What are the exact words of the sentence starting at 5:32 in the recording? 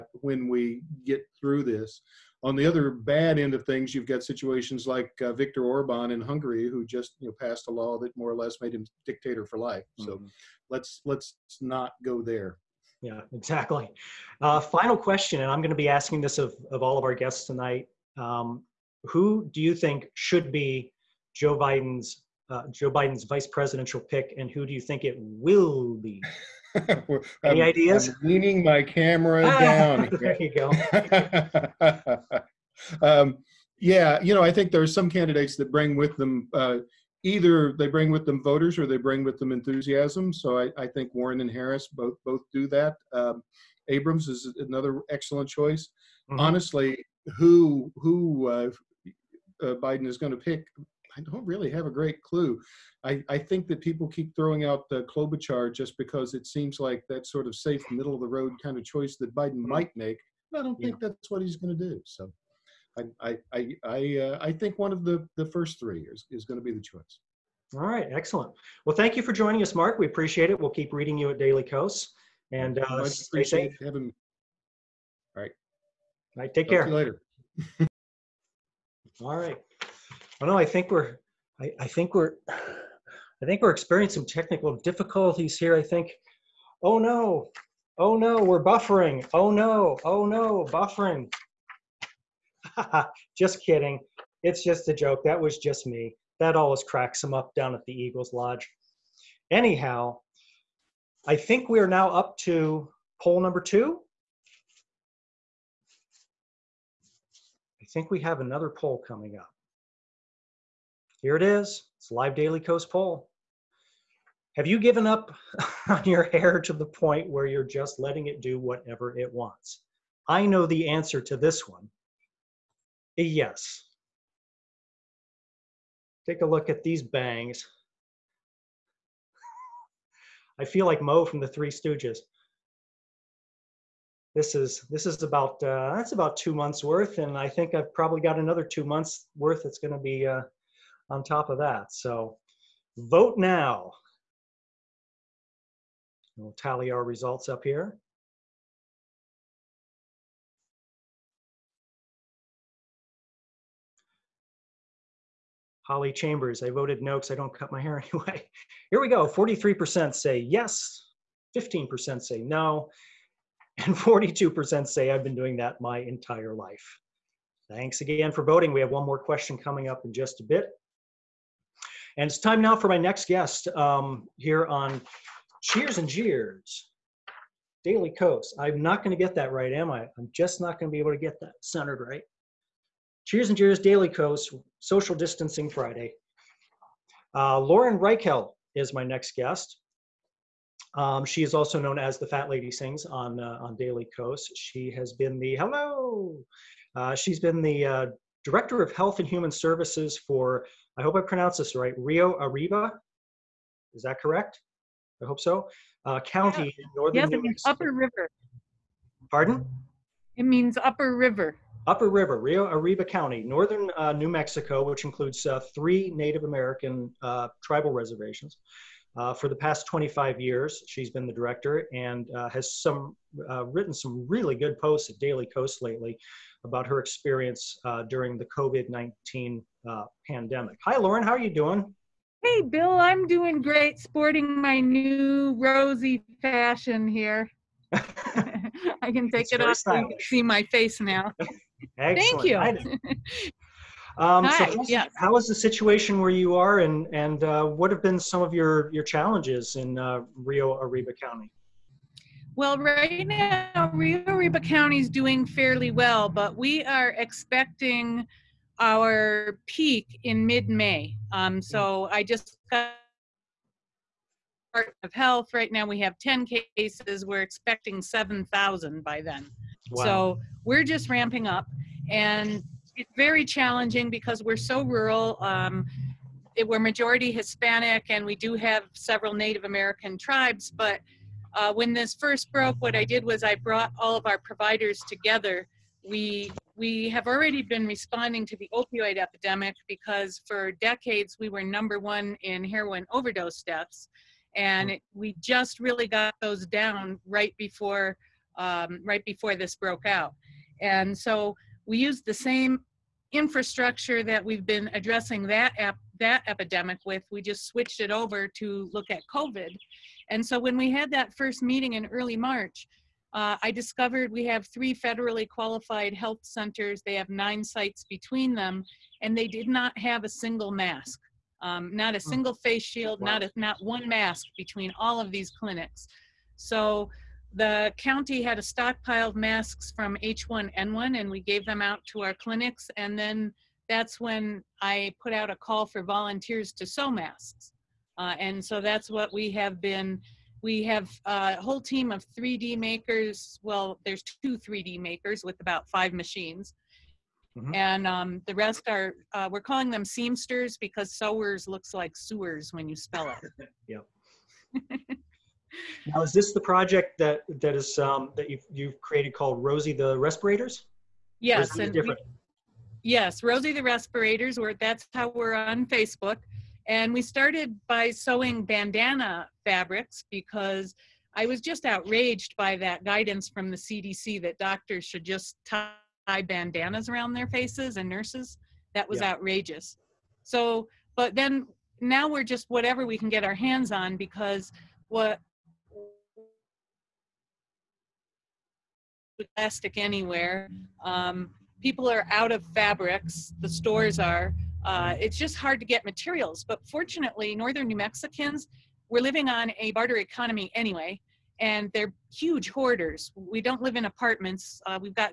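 And then that's when I put out a call for volunteers to sew masks.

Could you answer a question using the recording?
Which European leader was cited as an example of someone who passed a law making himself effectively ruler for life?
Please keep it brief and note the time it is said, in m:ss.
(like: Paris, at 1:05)
Viktor Orban, at 0:05.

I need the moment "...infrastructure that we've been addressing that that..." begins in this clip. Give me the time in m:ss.
5:03.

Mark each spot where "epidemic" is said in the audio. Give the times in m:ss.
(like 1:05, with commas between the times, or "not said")
4:49, 5:06.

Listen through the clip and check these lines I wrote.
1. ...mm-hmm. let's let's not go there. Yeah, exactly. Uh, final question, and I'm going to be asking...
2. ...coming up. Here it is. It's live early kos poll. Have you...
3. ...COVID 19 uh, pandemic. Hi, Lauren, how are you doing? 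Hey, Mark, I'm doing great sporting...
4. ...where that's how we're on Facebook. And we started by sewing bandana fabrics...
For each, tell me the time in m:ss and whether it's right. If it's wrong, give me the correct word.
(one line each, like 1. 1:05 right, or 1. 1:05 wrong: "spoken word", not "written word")
1. 0:10 right
2. 1:49 wrong: "daily", not "early"
3. 3:48 wrong: "Bill", not "Mark"
4. 6:04 right.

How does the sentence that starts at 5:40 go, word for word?
We have uh, a whole team of 3D makers.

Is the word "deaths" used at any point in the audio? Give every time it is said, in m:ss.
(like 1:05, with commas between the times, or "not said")
4:53.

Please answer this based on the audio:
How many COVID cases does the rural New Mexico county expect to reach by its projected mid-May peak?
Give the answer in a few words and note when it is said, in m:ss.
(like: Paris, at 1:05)
7,000, at 4:28.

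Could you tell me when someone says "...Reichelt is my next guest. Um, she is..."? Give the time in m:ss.
3:07.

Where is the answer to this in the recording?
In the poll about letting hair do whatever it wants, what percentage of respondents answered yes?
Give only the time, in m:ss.
2:39.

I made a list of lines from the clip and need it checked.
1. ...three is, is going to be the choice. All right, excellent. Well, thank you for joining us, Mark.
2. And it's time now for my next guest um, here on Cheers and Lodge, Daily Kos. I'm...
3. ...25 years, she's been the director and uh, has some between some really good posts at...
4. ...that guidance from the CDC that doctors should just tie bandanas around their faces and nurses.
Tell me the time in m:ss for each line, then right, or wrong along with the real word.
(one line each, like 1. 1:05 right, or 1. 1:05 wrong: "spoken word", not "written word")
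1. 1:05 right
2. 2:52 wrong: "Jeers", not "Lodge"
3. 3:39 wrong: "written", not "between"
4. 6:12 right.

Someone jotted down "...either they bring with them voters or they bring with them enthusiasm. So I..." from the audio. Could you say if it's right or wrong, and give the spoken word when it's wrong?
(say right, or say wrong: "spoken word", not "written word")
right.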